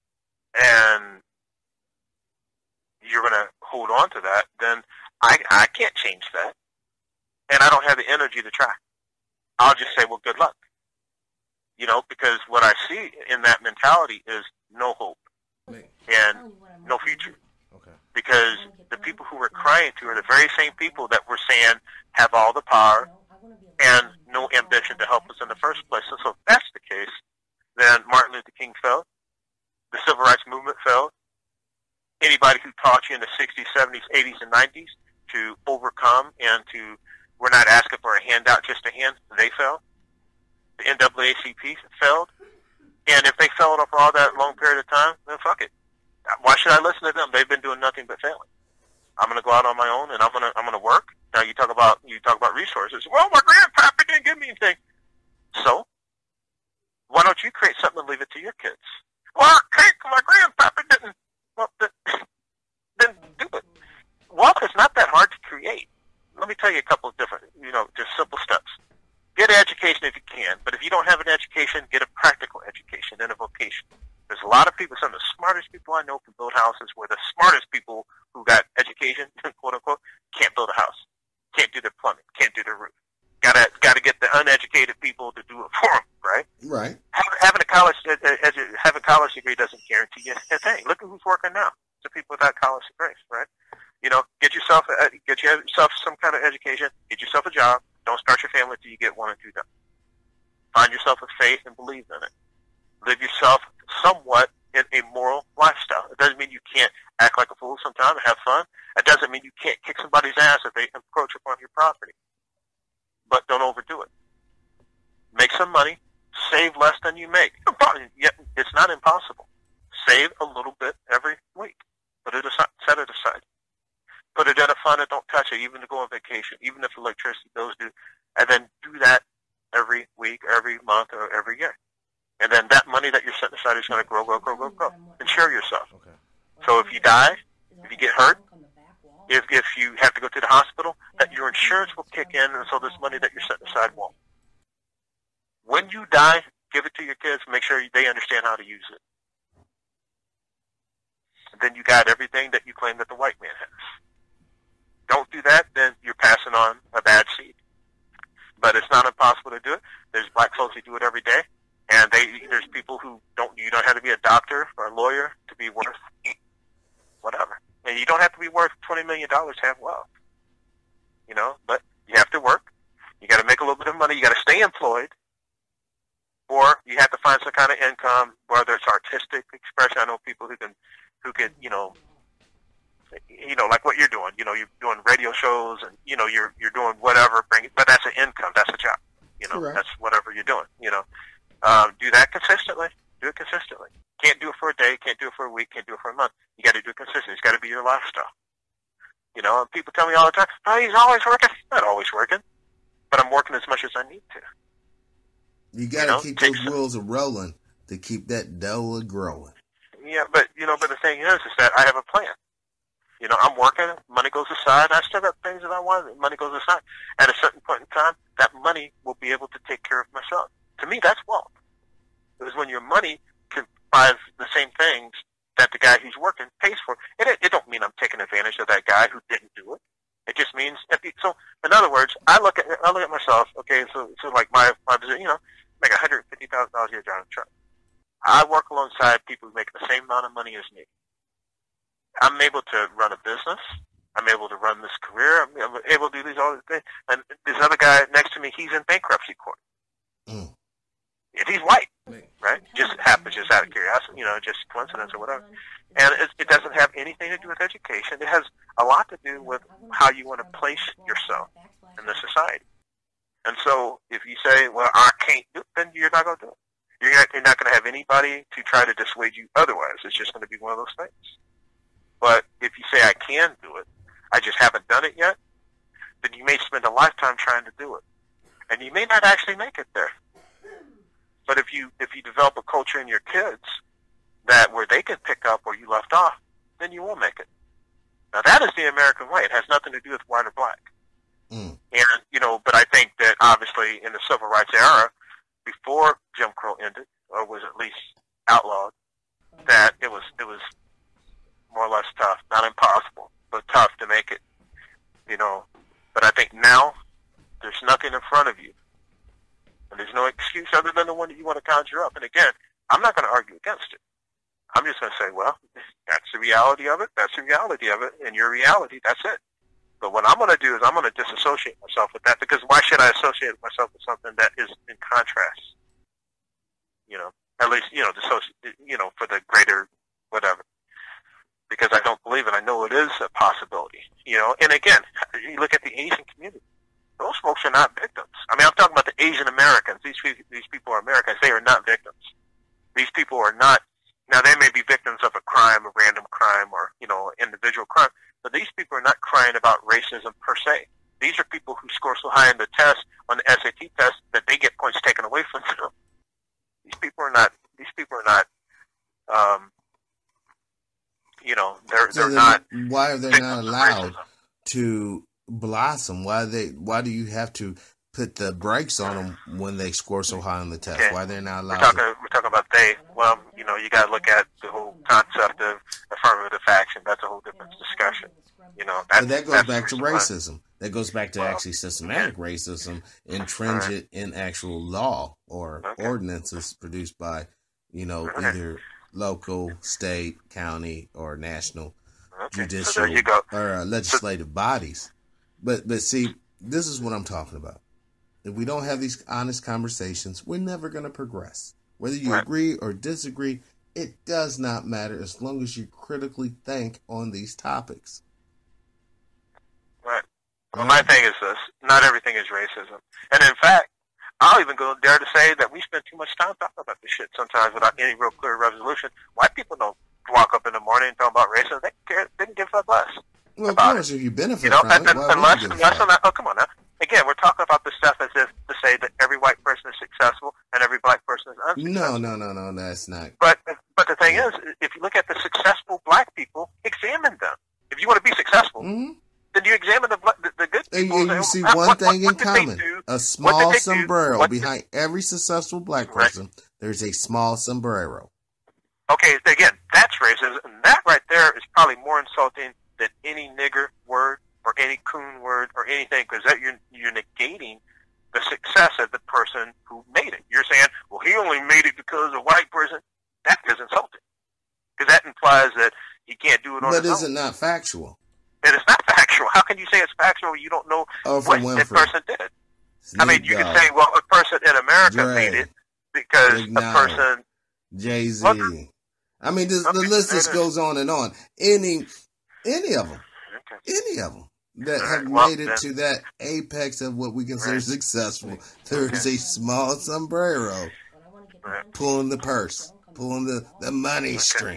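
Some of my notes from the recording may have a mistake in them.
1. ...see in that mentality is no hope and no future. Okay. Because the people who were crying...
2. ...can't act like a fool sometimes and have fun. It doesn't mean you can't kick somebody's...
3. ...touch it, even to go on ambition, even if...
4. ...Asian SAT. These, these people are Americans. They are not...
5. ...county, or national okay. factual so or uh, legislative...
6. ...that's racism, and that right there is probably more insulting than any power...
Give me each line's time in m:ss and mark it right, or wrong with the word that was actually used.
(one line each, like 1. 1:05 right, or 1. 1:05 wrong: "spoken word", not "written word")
1. 0:12 right
2. 1:46 right
3. 2:05 wrong: "vacation", not "ambition"
4. 5:39 wrong: "Americans", not "SAT"
5. 6:30 wrong: "judicial", not "factual"
6. 7:29 wrong: "nigger", not "power".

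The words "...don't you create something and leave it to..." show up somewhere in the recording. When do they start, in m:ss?
0:57.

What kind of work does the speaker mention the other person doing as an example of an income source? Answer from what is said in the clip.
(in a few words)
radio shows.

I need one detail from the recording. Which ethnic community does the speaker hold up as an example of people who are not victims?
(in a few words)
Asian community.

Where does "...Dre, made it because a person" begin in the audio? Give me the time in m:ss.
7:55.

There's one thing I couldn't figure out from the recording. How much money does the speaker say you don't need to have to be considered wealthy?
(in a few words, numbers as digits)
$20 million.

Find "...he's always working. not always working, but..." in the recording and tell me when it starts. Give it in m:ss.
3:20.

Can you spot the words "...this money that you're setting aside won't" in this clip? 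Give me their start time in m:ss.
2:22.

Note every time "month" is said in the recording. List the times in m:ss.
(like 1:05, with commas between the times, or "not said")
2:10.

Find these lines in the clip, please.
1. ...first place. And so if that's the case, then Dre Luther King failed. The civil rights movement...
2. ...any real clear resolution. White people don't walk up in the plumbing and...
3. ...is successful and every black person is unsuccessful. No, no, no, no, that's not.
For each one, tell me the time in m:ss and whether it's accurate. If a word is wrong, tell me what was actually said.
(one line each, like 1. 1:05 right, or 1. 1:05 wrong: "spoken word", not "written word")
1. 0:25 wrong: "Martin", not "Dre"
2. 6:57 wrong: "morning", not "plumbing"
3. 7:09 right.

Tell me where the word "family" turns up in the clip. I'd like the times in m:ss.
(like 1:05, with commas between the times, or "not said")
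1:38.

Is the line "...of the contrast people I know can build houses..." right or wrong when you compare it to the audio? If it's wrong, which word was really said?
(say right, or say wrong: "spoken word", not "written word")
wrong: "smartest", not "contrast".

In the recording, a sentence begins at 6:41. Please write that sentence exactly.
Whether you agree or disagree, it does not matter as long as you critically think on these topics.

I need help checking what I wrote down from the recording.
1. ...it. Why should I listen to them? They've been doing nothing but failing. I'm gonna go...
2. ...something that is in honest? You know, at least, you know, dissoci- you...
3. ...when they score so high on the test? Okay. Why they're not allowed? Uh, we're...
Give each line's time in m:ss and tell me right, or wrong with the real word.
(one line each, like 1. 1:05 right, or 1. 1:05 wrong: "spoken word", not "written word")
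1. 0:45 right
2. 5:24 wrong: "contrast", not "honest"
3. 6:09 right.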